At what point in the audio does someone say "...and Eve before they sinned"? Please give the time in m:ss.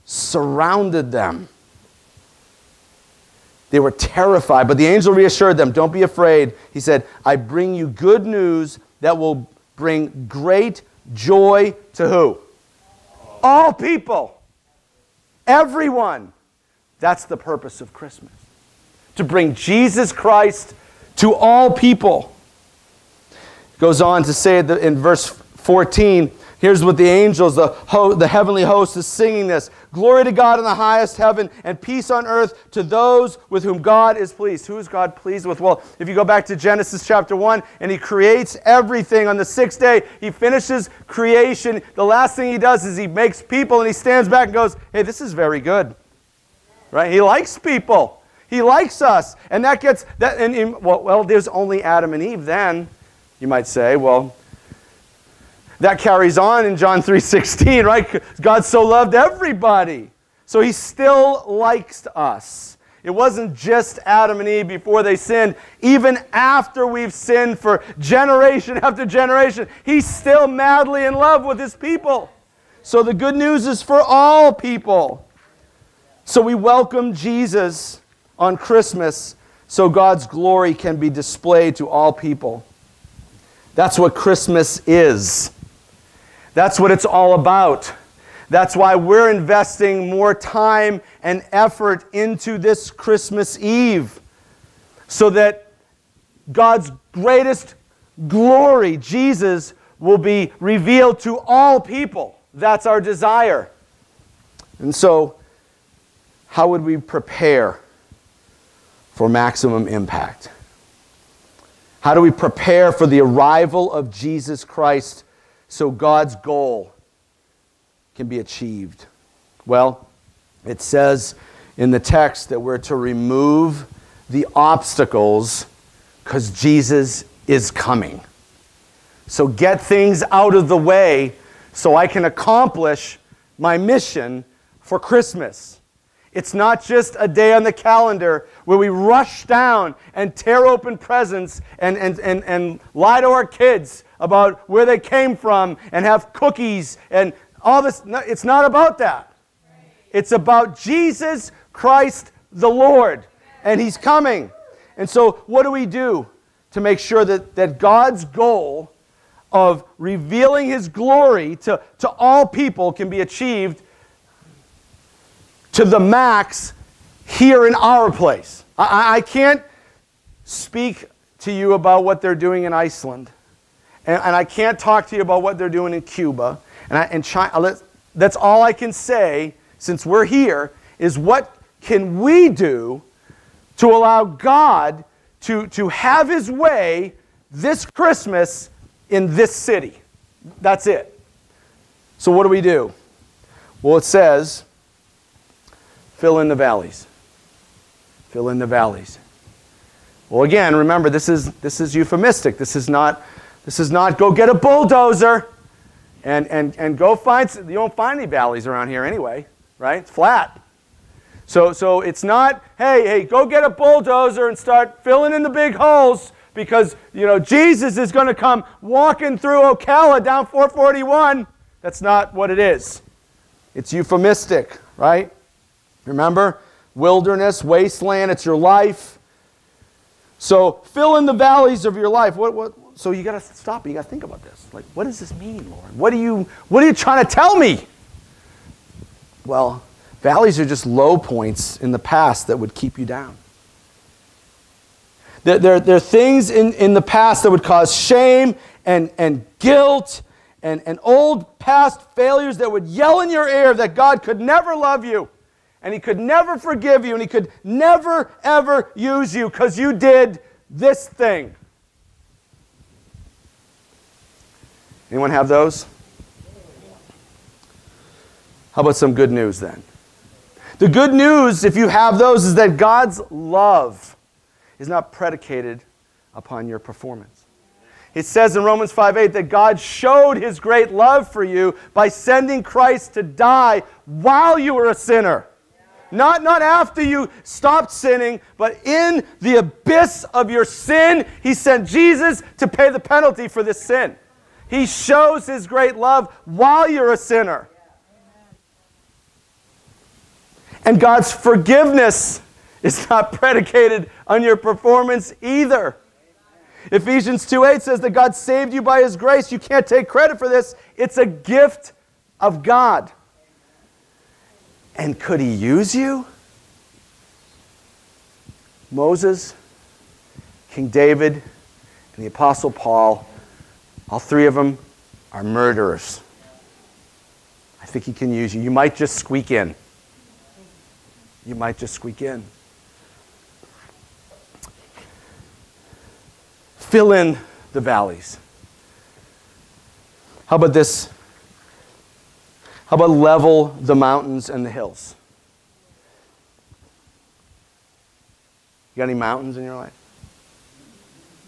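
1:04.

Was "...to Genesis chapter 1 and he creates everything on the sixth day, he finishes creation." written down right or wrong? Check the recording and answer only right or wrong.
right.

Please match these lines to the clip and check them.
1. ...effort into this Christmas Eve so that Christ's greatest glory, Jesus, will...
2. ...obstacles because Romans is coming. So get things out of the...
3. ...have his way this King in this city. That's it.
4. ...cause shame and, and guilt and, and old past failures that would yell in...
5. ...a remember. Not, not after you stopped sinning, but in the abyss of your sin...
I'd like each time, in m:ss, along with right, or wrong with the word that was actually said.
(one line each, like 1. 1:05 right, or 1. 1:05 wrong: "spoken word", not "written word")
1. 1:31 wrong: "God", not "Christ"
2. 2:04 wrong: "Jesus", not "Romans"
3. 3:05 wrong: "Christmas", not "King"
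4. 4:07 right
5. 4:44 wrong: "sinner", not "remember".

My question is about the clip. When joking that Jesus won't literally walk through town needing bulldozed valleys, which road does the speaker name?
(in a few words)
441.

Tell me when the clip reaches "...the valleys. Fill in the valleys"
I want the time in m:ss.
3:16.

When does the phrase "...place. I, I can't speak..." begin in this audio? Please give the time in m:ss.
2:48.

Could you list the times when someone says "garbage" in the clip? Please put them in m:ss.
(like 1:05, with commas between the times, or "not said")
not said.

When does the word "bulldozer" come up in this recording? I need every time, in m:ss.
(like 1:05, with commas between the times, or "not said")
3:24, 3:33.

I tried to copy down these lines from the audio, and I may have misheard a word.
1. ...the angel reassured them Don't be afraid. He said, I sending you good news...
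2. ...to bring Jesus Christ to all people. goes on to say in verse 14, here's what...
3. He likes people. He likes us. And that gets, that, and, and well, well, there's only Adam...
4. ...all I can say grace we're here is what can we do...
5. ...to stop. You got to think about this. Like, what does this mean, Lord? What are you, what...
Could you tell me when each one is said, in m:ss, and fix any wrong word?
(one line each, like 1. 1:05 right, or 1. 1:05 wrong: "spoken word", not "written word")
1. 0:04 wrong: "bring", not "sending"
2. 0:19 right
3. 0:47 right
4. 2:58 wrong: "since", not "grace"
5. 3:53 right.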